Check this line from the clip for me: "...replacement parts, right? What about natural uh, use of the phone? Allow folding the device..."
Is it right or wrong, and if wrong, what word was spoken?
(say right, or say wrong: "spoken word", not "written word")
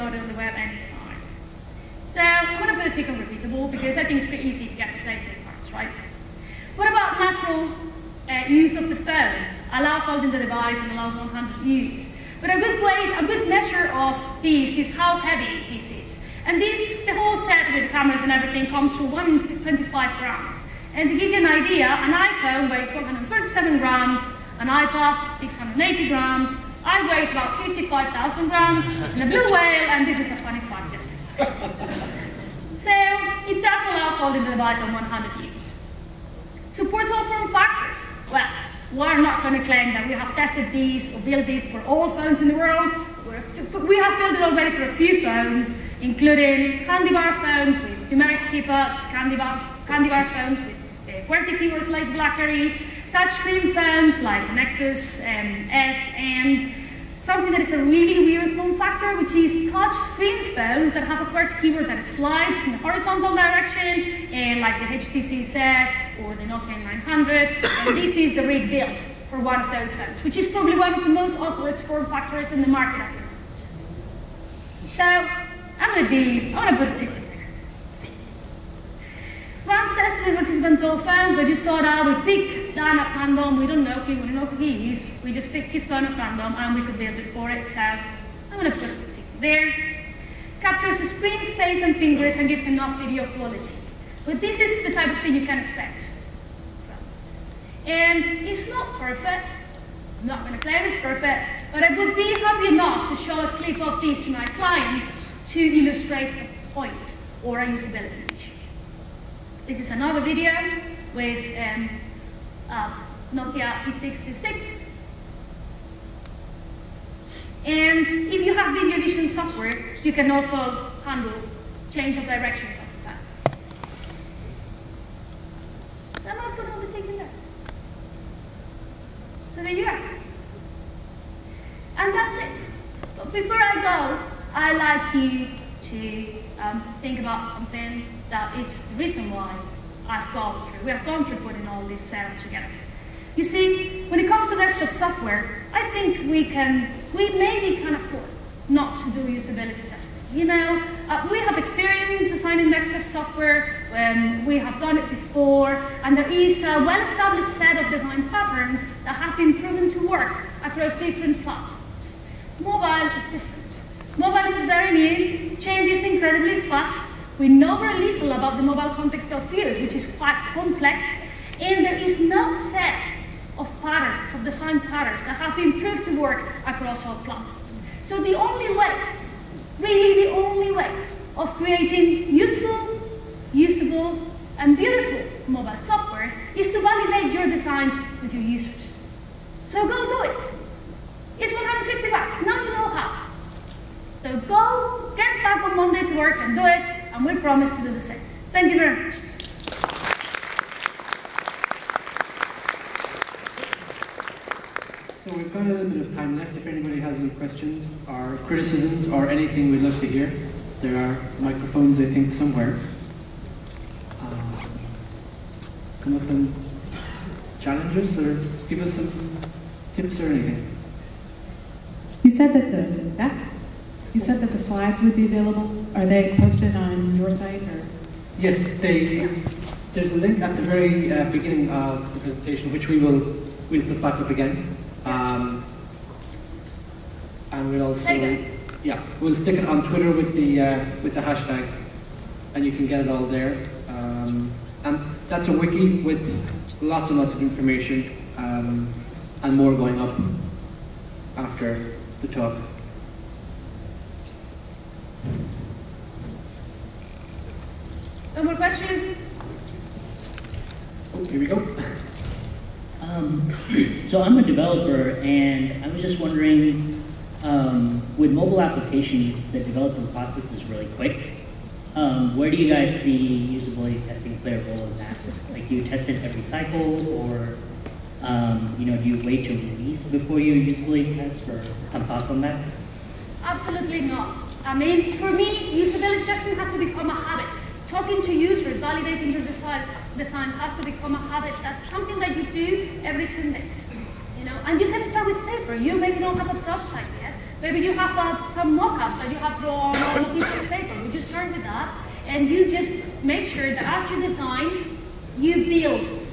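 right.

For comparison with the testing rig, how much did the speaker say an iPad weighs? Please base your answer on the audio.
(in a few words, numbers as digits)
680 grams.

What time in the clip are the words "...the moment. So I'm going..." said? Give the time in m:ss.
1:13.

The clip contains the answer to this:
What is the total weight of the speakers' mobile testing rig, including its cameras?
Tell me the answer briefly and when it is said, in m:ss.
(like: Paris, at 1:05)
125 grams, at 0:19.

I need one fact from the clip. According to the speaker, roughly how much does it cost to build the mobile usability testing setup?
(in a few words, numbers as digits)
150 bucks.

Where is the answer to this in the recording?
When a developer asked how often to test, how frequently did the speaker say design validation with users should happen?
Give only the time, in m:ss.
4:53.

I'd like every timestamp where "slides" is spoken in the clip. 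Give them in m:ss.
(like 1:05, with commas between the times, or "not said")
1:02, 3:44.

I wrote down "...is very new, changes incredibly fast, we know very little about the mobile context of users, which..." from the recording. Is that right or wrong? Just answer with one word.
right.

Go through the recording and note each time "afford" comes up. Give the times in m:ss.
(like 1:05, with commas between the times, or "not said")
2:27.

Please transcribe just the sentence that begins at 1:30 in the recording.
Captures the screen, face and fingers and gives enough video quality.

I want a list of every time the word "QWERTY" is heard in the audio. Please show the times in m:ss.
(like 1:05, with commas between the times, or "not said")
0:51, 1:01.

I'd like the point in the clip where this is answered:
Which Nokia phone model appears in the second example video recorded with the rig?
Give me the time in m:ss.
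1:53.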